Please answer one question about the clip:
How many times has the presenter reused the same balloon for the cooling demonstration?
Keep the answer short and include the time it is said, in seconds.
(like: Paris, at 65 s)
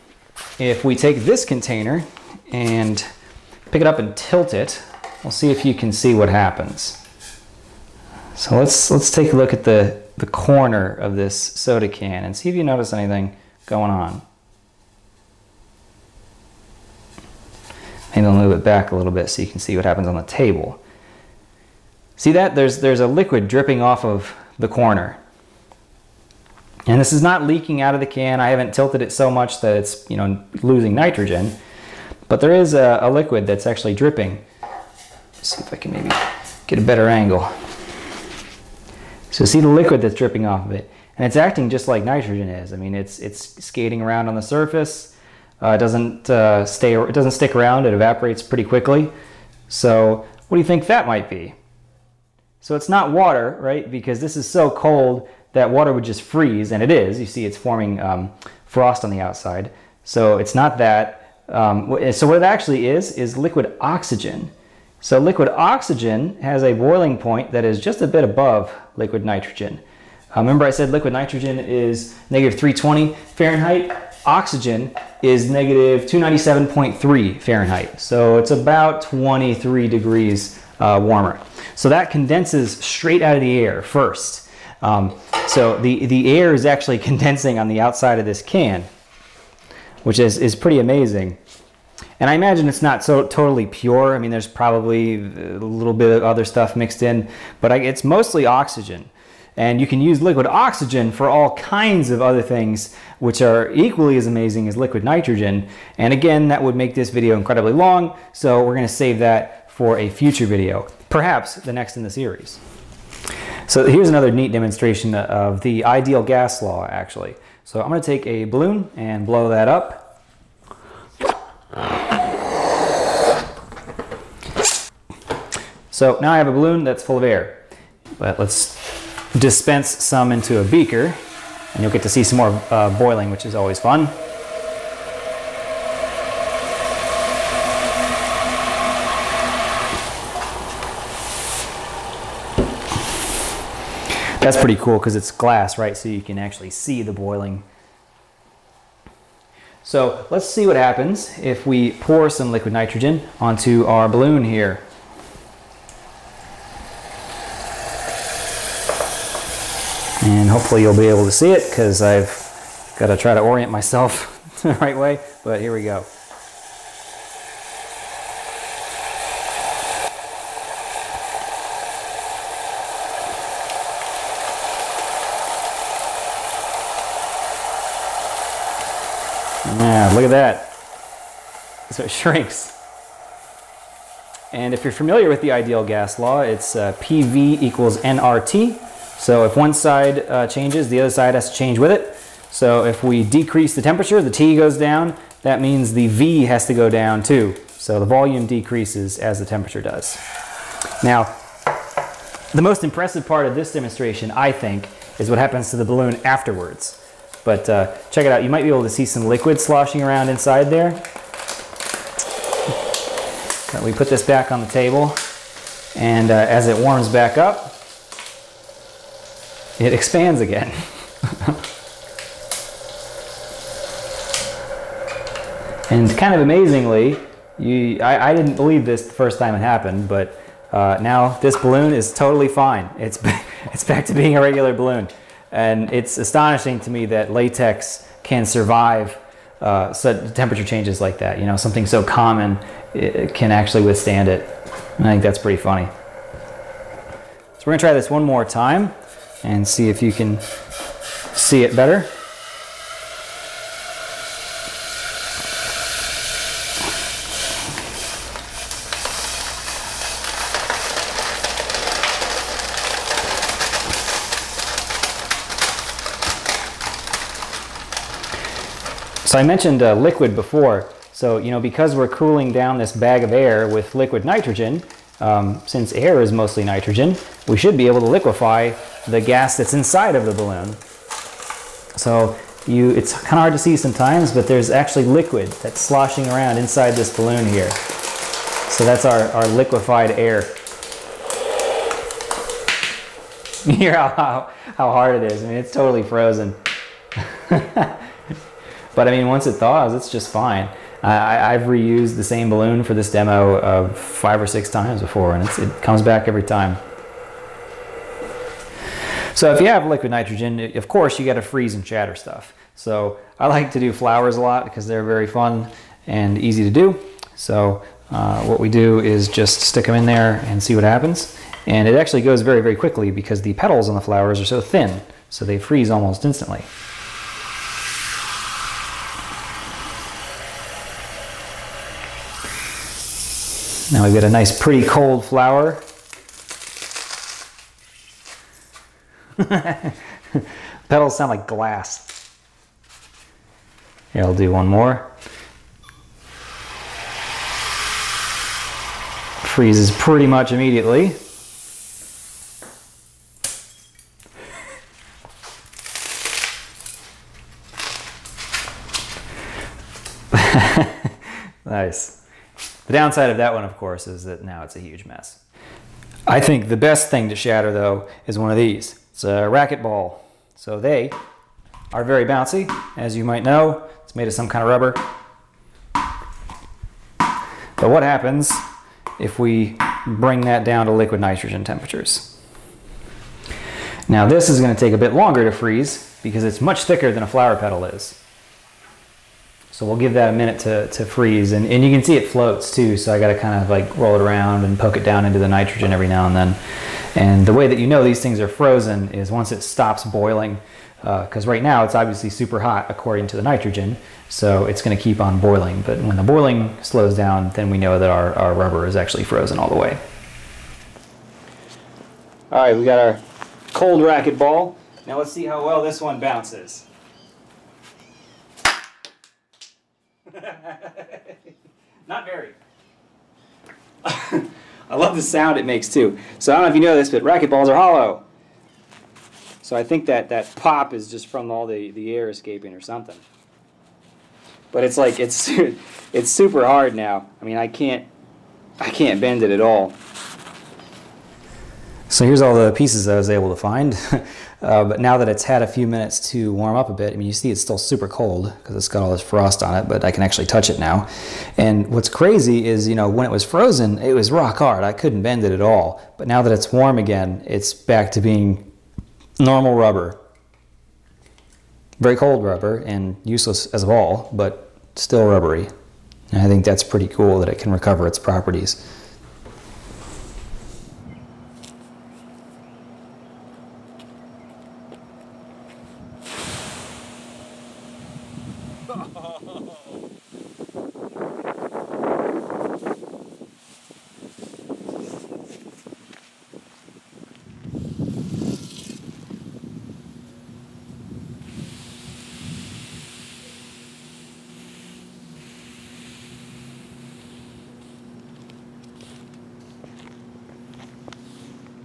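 5 or 6 times, at 303 s.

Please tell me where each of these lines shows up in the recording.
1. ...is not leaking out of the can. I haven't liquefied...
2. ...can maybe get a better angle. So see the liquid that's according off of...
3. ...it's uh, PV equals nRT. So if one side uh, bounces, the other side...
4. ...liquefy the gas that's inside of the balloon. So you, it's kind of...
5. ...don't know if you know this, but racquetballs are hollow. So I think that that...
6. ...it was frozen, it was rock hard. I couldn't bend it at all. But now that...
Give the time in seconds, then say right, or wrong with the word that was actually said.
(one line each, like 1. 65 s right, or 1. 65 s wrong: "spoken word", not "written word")
1. 27 s wrong: "tilted", not "liquefied"
2. 35 s wrong: "dripping", not "according"
3. 186 s wrong: "changes", not "bounces"
4. 278 s right
5. 426 s right
6. 453 s right.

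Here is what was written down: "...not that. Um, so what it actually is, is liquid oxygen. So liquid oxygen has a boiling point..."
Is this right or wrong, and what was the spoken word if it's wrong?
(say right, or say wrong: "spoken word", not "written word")
right.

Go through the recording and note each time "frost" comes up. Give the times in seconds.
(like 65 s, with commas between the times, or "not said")
58 s, 449 s.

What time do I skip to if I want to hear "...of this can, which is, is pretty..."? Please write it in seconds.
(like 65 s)
88 s.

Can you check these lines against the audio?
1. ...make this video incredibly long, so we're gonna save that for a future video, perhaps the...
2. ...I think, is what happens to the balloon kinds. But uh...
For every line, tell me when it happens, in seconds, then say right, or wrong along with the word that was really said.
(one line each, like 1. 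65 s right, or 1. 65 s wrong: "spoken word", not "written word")
1. 106 s right
2. 204 s wrong: "afterwards", not "kinds".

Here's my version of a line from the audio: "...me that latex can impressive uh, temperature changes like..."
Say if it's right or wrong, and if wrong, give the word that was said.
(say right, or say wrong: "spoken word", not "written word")
wrong: "survive", not "impressive".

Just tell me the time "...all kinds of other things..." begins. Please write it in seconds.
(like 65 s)
101 s.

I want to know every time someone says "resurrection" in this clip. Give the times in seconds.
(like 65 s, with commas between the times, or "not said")
not said.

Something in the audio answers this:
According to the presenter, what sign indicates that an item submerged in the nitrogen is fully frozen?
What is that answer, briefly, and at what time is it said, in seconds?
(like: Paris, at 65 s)
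It stops boiling, at 399 s.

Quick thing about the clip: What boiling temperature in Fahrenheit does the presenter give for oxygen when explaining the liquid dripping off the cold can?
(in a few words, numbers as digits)
-297.3 Fahrenheit.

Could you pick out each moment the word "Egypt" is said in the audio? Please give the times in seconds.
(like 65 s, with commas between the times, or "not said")
not said.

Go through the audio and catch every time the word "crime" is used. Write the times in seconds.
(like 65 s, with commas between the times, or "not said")
not said.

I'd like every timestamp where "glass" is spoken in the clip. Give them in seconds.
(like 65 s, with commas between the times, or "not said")
145 s, 341 s.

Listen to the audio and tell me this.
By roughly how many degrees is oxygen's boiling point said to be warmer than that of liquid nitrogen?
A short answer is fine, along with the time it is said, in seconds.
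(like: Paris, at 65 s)
23 degrees, at 79 s.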